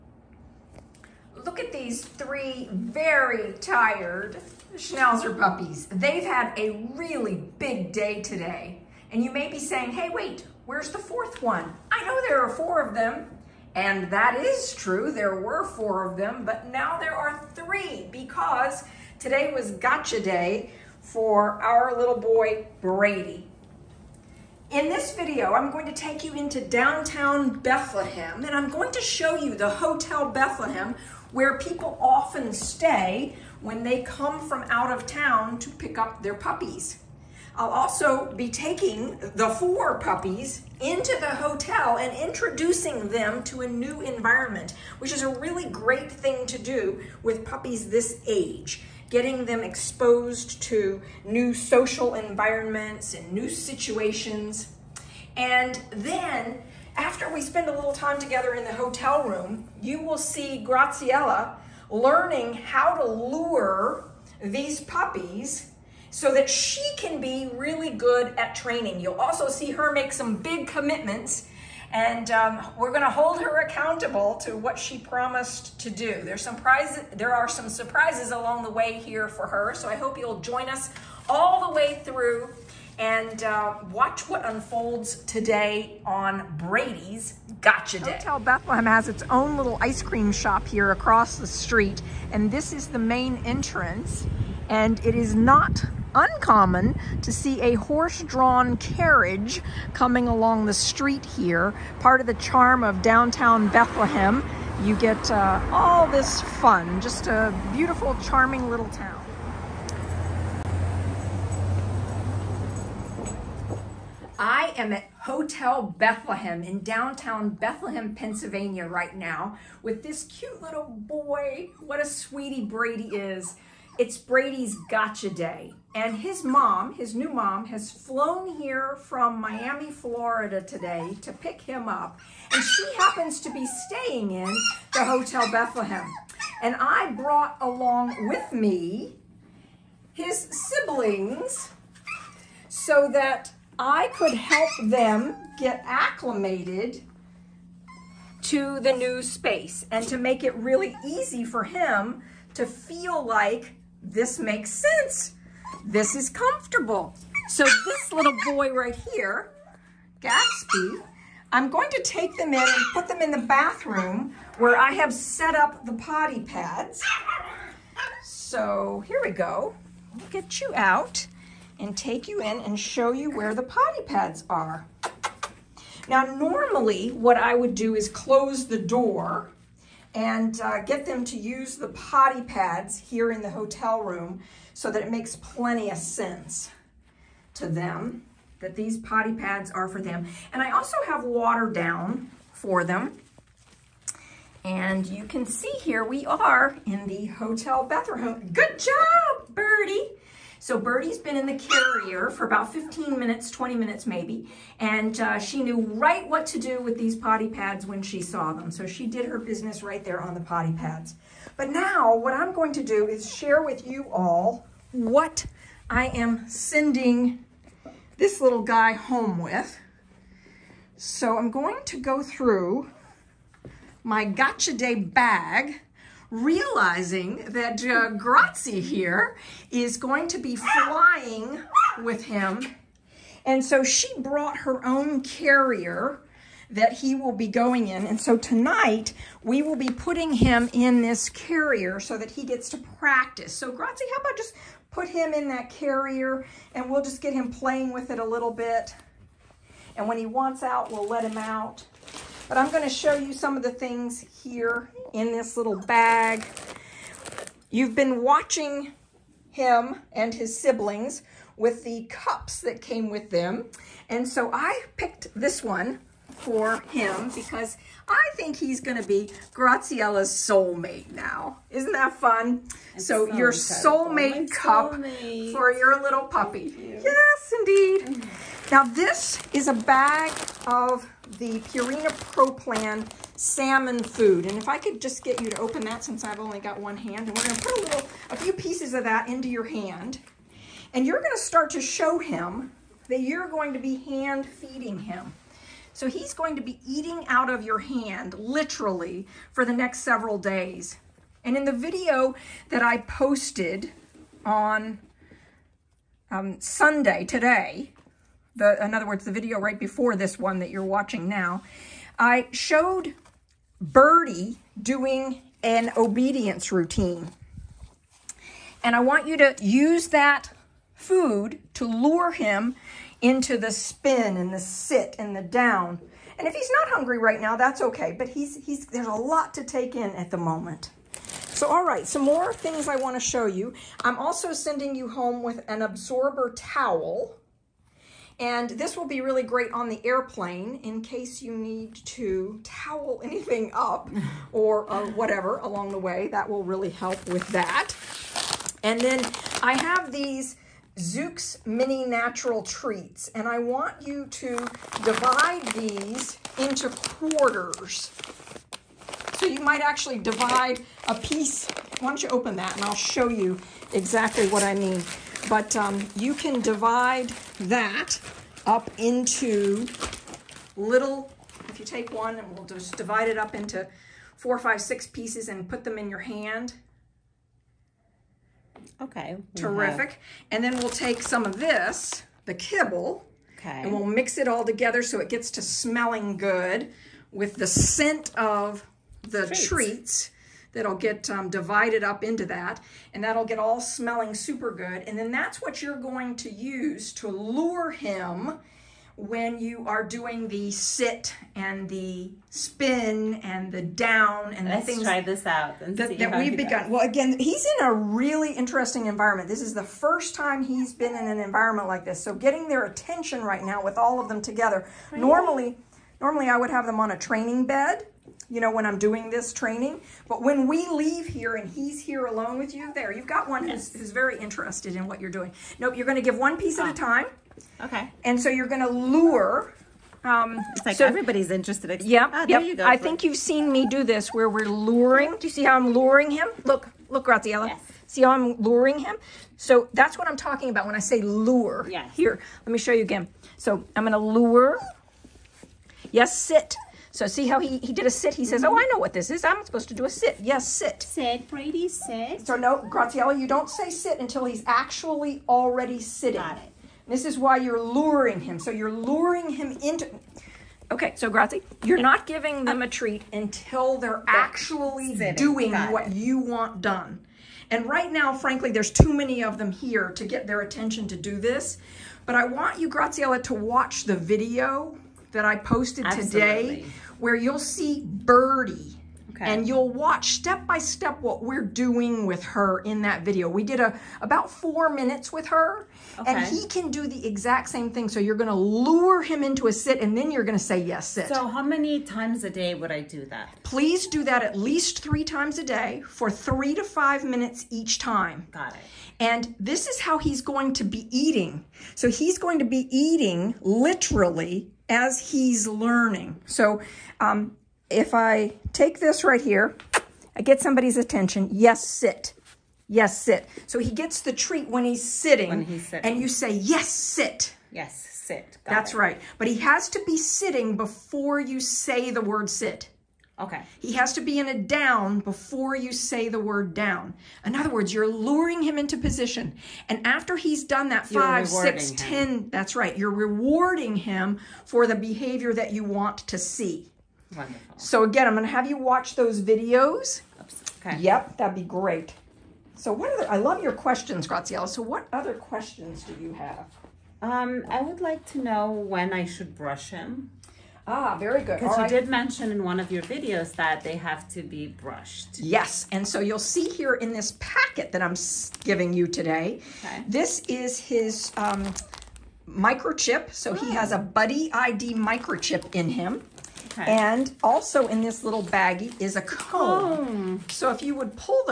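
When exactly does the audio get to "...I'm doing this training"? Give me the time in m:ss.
6:58.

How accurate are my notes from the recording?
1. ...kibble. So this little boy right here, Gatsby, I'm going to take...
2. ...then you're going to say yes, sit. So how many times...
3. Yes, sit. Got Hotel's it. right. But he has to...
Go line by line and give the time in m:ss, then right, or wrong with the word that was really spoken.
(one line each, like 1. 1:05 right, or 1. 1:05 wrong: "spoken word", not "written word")
1. 2:36 wrong: "comfortable", not "kibble"
2. 8:10 right
3. 8:37 wrong: "That", not "Hotel".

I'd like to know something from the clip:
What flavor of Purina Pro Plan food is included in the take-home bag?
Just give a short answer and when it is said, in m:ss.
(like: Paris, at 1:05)
Salmon, at 4:43.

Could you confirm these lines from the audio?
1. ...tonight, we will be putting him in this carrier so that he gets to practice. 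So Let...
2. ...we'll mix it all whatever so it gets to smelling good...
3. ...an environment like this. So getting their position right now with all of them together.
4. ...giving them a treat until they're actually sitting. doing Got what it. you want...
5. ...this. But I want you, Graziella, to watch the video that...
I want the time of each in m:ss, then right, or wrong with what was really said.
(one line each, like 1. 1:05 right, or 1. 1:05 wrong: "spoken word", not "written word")
1. 3:58 wrong: "Grazi", not "Let"
2. 6:23 wrong: "together", not "whatever"
3. 6:51 wrong: "attention", not "position"
4. 7:42 right
5. 7:51 right.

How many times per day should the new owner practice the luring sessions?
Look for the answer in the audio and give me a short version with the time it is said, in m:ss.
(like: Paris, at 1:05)
3, at 8:15.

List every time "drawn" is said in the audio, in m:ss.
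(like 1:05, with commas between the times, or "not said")
1:37.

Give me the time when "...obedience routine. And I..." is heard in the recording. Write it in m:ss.
5:15.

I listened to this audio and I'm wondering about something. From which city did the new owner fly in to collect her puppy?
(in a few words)
Miami, Florida.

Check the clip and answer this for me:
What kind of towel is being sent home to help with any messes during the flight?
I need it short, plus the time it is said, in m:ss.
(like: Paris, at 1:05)
Absorber towel, at 5:35.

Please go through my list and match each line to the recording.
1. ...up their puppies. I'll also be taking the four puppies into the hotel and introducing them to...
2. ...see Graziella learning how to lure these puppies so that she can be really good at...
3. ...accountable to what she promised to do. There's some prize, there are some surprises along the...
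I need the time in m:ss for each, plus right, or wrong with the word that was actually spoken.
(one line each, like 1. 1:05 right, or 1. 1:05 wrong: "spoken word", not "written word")
1. 0:35 right
2. 1:00 right
3. 1:13 right.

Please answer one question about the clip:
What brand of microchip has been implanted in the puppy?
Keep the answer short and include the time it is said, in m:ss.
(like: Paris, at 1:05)
Buddy ID, at 9:23.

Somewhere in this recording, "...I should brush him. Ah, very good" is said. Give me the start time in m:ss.
9:09.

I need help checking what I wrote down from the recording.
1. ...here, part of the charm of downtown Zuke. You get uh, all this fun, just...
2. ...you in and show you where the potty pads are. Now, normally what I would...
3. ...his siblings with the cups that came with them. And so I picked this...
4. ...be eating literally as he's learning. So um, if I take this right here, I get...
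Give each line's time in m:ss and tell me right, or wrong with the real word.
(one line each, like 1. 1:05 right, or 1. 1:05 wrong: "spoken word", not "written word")
1. 1:41 wrong: "Bethlehem", not "Zuke"
2. 2:52 right
3. 4:20 right
4. 8:22 right.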